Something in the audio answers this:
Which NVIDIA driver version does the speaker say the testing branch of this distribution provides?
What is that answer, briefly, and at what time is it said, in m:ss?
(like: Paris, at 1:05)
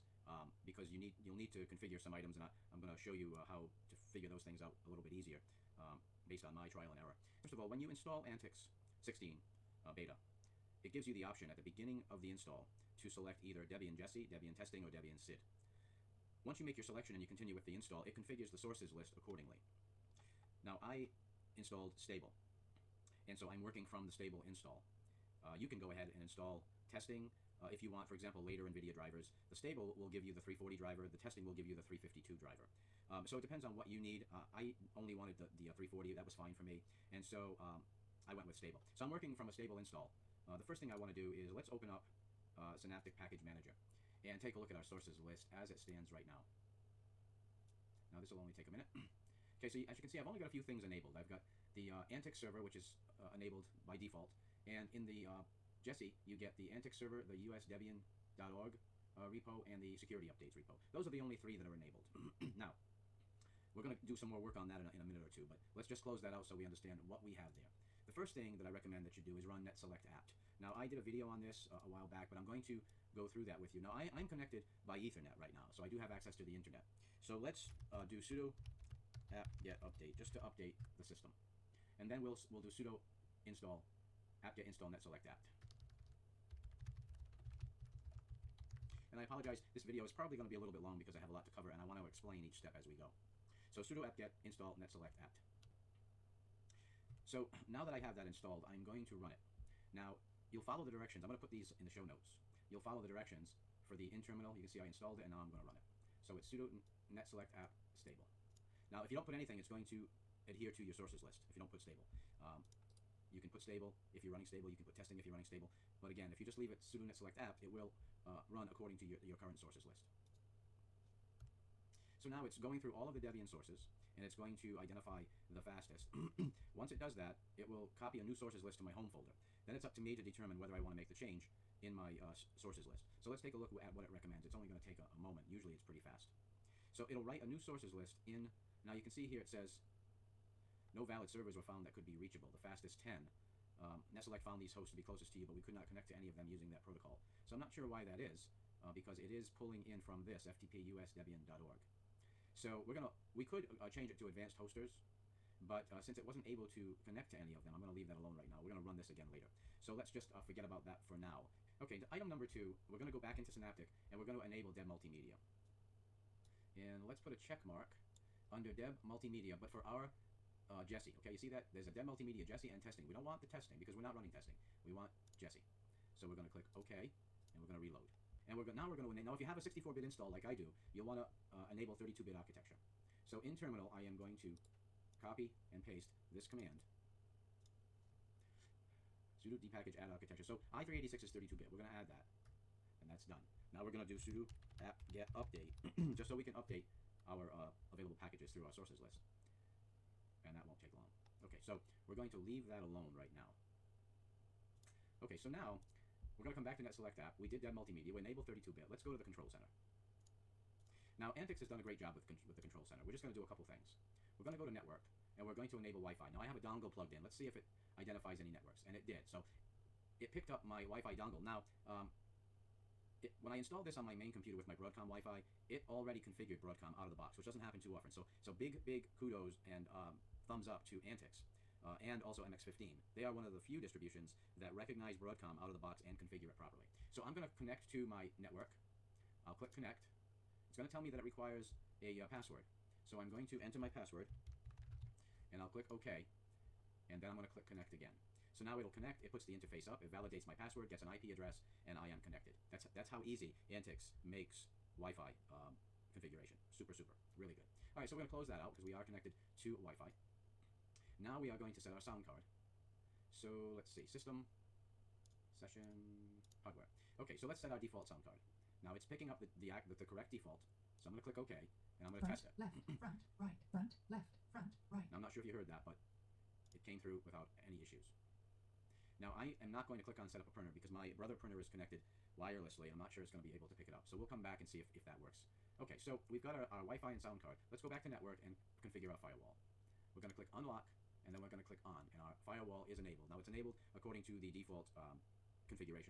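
352, at 0:31.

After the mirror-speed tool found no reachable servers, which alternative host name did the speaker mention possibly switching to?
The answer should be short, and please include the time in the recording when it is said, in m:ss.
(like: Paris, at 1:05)
Advanced Hosters, at 2:34.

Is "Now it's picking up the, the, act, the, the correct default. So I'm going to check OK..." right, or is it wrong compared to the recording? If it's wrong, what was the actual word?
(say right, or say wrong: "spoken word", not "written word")
wrong: "click", not "check".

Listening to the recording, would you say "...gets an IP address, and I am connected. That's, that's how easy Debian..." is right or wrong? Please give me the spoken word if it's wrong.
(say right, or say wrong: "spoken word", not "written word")
wrong: "Antix", not "Debian".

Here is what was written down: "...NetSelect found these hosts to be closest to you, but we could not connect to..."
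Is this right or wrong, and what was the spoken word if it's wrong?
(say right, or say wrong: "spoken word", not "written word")
right.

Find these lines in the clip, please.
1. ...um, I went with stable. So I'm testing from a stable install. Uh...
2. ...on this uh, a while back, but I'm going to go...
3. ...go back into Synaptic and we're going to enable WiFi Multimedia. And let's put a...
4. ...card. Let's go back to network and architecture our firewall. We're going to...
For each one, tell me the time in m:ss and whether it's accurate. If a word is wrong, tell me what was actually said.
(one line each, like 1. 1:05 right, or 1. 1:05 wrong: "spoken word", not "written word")
1. 0:37 wrong: "working", not "testing"
2. 1:11 right
3. 2:43 wrong: "Deb", not "WiFi"
4. 4:47 wrong: "configure", not "architecture".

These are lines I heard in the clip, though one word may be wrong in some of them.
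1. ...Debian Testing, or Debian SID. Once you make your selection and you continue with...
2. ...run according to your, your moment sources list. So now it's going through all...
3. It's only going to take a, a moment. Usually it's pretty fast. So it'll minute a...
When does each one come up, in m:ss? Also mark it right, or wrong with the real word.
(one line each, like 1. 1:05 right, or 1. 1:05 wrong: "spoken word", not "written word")
1. 0:14 right
2. 1:58 wrong: "current", not "moment"
3. 2:14 wrong: "write", not "minute".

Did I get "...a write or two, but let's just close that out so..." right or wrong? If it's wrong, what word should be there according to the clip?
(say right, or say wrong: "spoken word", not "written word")
wrong: "minute", not "write".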